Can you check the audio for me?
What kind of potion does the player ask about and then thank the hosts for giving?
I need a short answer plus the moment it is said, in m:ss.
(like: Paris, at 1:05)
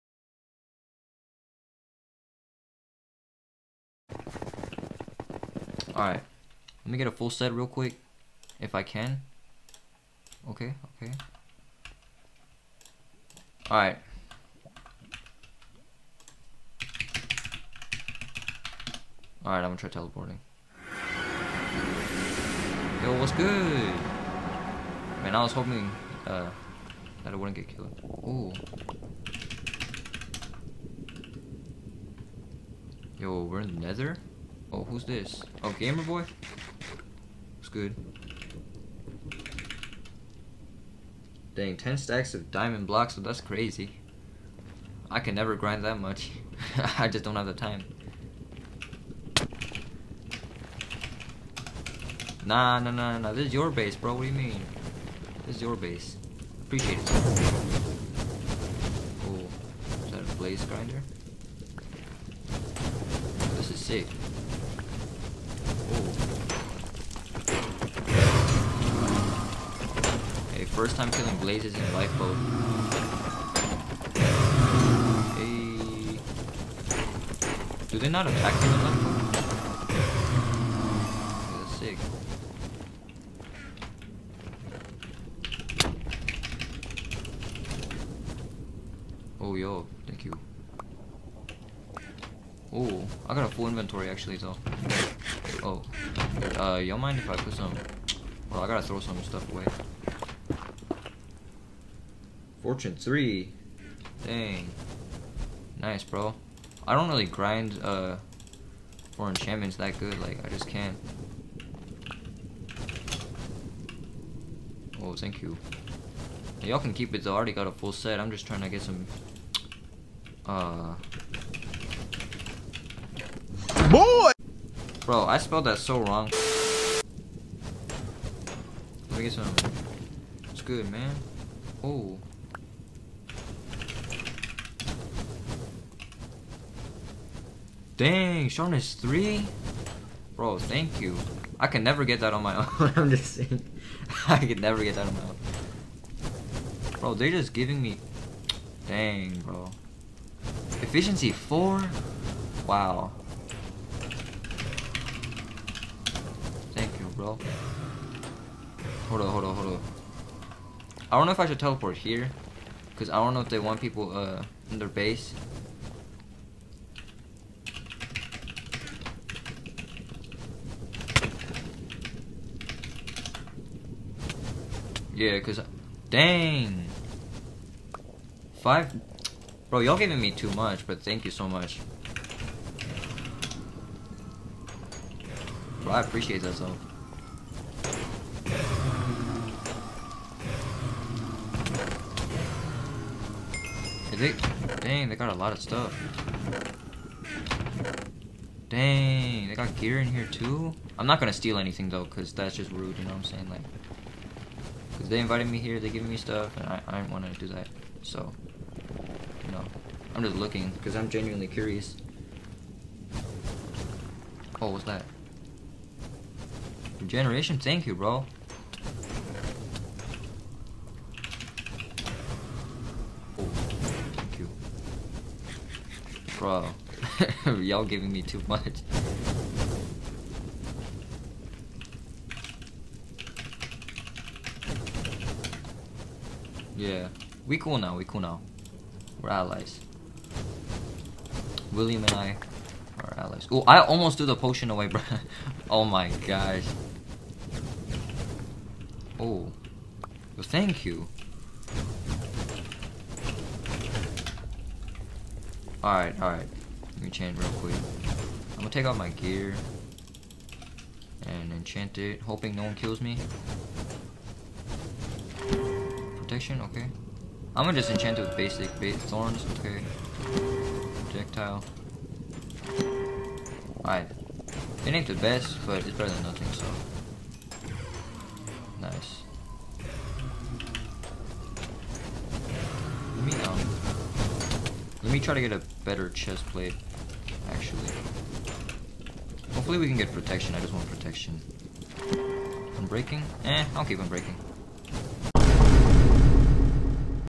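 Regeneration, at 3:36.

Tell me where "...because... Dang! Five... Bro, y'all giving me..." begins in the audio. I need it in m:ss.
2:55.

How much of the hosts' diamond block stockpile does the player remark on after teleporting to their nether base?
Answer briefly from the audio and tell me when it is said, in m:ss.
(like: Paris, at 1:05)
10 stacks, at 0:41.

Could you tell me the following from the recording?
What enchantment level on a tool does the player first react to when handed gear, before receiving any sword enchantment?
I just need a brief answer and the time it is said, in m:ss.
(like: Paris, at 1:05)
Fortune 3, at 1:42.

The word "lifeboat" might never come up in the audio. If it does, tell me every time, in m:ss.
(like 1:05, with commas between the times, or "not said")
1:11, 1:18.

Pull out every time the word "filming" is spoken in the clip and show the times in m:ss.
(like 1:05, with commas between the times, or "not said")
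not said.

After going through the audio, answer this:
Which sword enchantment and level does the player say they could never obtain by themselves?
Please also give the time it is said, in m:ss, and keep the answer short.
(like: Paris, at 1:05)
Sharpness 3, at 2:18.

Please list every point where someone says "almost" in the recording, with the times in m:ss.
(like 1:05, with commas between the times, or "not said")
4:03.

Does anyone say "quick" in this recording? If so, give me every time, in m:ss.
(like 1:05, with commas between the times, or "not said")
0:07, 4:17.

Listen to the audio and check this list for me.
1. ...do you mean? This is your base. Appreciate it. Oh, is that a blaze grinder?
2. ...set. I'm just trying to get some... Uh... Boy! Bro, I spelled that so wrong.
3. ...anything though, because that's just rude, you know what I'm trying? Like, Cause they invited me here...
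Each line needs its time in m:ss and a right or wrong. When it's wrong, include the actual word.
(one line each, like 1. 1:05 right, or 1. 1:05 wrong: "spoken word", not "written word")
1. 0:54 right
2. 1:57 right
3. 3:21 wrong: "saying", not "trying".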